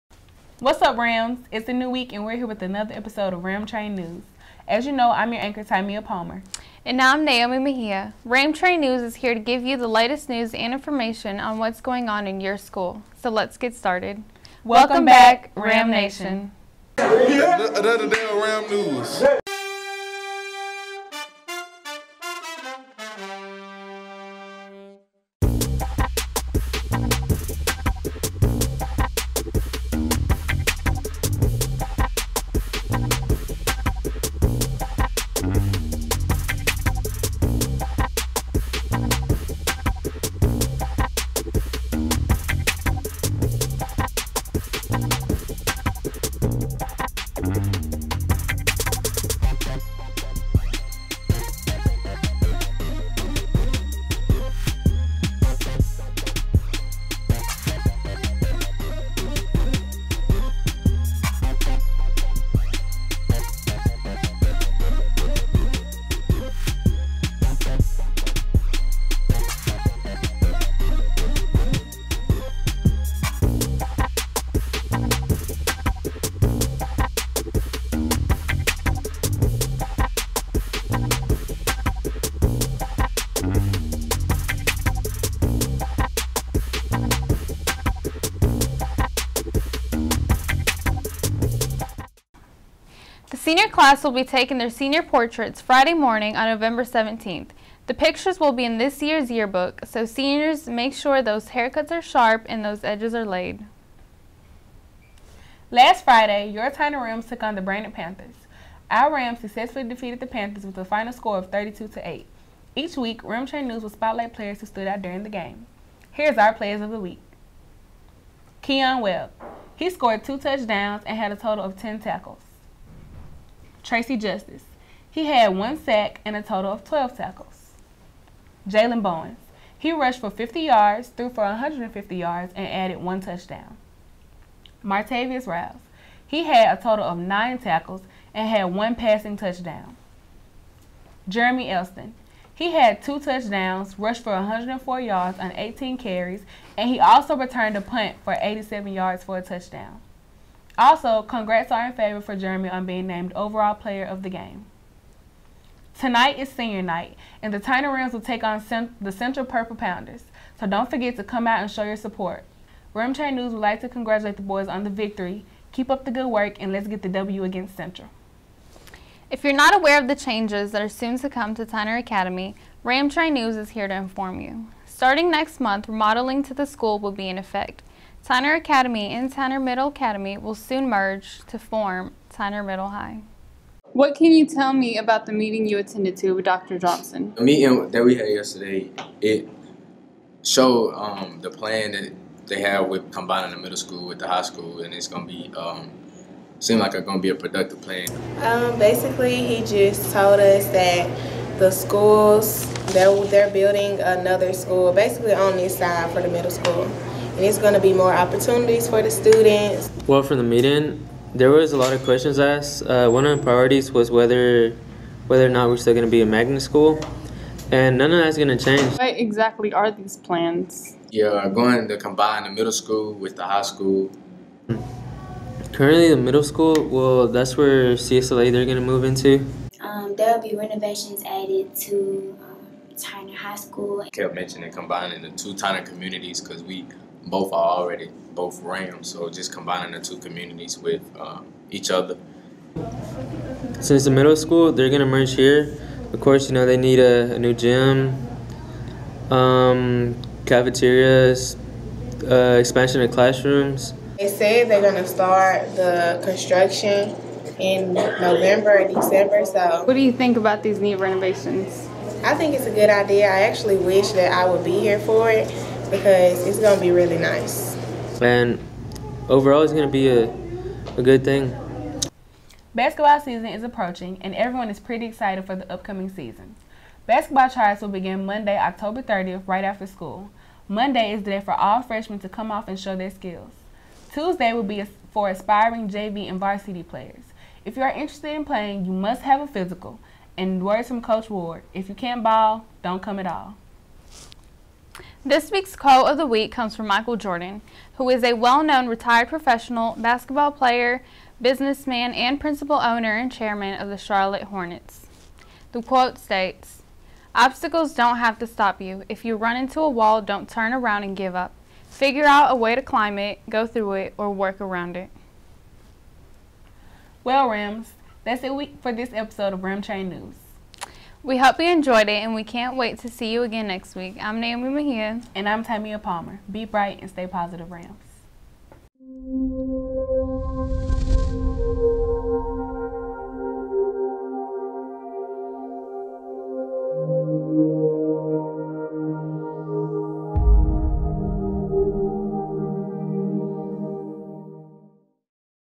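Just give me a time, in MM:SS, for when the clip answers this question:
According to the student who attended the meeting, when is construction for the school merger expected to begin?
04:17.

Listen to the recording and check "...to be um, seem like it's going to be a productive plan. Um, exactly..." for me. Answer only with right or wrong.
wrong.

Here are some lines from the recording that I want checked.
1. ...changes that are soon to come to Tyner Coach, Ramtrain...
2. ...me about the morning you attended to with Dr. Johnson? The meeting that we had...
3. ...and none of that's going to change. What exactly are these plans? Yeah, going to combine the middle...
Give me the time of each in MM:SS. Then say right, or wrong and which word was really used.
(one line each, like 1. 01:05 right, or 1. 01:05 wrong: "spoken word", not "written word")
1. 02:50 wrong: "Academy", not "Coach"
2. 03:04 wrong: "meeting", not "morning"
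3. 03:37 right.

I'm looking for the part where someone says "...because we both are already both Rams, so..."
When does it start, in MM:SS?
03:56.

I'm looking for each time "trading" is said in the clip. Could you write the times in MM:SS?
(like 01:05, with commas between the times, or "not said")
not said.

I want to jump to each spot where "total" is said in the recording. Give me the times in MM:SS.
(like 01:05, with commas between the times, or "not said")
02:01, 02:06, 02:16.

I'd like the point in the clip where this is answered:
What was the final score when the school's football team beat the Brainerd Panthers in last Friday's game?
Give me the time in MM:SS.
01:51.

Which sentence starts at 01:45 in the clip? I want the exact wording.
Last Friday, your Tyner Rams took on the Brainerd Panthers.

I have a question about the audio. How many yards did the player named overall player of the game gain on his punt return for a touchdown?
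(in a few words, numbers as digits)
87.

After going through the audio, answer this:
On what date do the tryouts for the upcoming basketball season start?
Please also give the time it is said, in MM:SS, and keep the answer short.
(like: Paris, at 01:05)
Monday, October 30th, at 04:38.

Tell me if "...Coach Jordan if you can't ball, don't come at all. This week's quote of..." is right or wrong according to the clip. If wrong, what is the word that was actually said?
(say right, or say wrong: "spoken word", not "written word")
wrong: "Ward", not "Jordan".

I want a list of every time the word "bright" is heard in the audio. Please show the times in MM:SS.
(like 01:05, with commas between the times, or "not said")
05:26.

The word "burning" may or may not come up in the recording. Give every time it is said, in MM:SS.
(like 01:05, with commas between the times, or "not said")
not said.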